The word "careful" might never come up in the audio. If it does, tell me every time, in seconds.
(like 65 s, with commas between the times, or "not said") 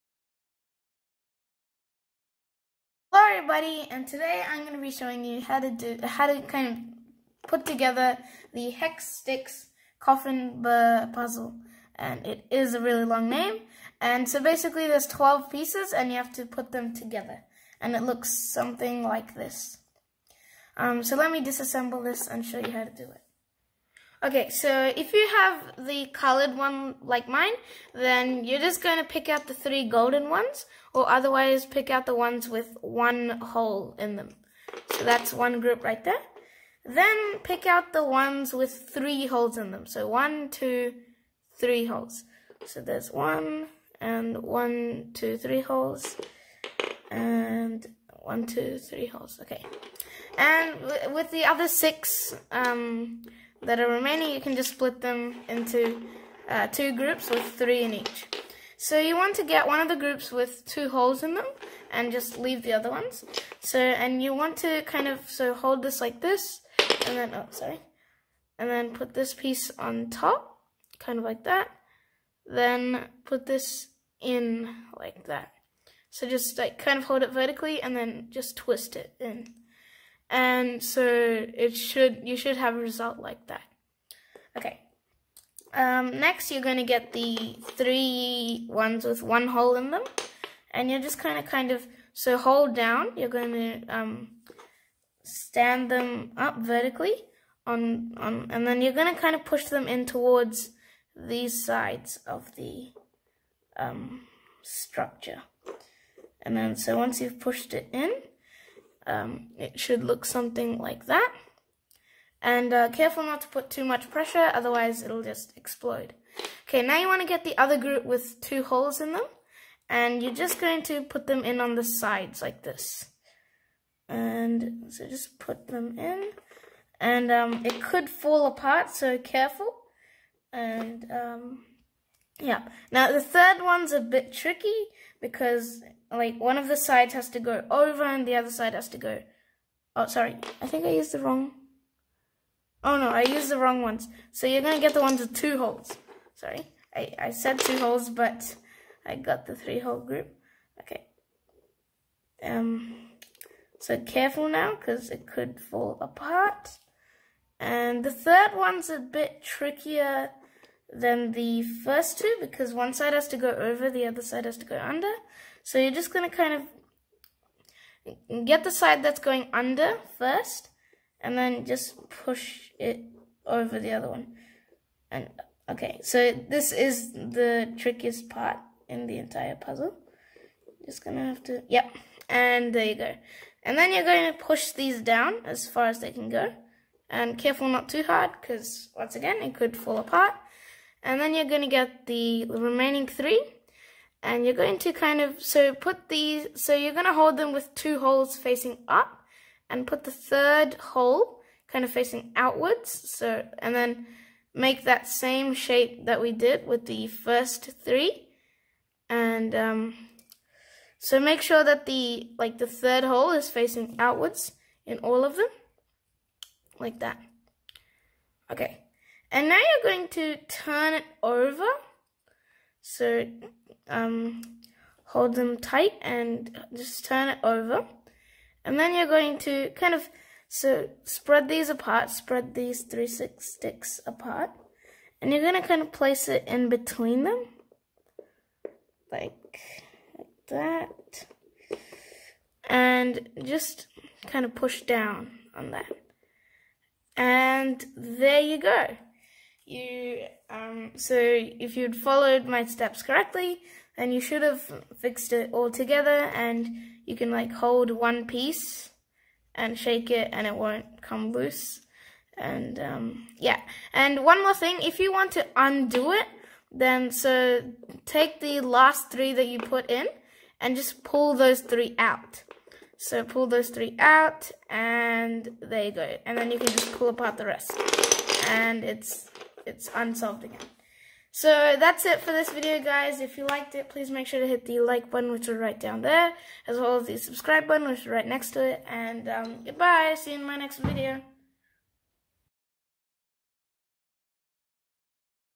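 112 s, 129 s, 153 s, 187 s.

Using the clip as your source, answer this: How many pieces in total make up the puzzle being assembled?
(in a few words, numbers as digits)
12.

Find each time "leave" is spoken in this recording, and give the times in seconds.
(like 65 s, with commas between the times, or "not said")
62 s.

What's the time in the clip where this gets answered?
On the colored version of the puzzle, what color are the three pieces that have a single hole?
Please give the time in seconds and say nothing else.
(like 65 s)
29 s.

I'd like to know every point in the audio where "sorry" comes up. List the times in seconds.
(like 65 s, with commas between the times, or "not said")
67 s, 140 s, 146 s.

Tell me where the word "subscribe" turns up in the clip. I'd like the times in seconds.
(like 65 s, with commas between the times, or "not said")
287 s.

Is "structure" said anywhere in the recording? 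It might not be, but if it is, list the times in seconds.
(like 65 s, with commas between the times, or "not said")
104 s.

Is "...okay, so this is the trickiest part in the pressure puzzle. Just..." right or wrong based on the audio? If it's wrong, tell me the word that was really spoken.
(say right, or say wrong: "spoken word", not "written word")
wrong: "entire", not "pressure".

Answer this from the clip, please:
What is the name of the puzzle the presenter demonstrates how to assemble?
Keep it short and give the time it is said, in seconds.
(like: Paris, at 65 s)
Hex Sticks Coffin, at 8 s.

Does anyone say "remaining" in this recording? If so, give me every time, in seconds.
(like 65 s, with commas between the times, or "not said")
53 s, 192 s.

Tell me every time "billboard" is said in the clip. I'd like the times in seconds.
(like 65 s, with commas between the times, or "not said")
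not said.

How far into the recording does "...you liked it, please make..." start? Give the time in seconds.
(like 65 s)
283 s.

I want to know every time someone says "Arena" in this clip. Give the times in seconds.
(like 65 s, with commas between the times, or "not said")
not said.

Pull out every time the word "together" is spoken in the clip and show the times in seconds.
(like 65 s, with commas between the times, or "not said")
7 s, 16 s, 255 s.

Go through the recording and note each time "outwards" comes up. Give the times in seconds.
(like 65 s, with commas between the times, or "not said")
202 s, 213 s.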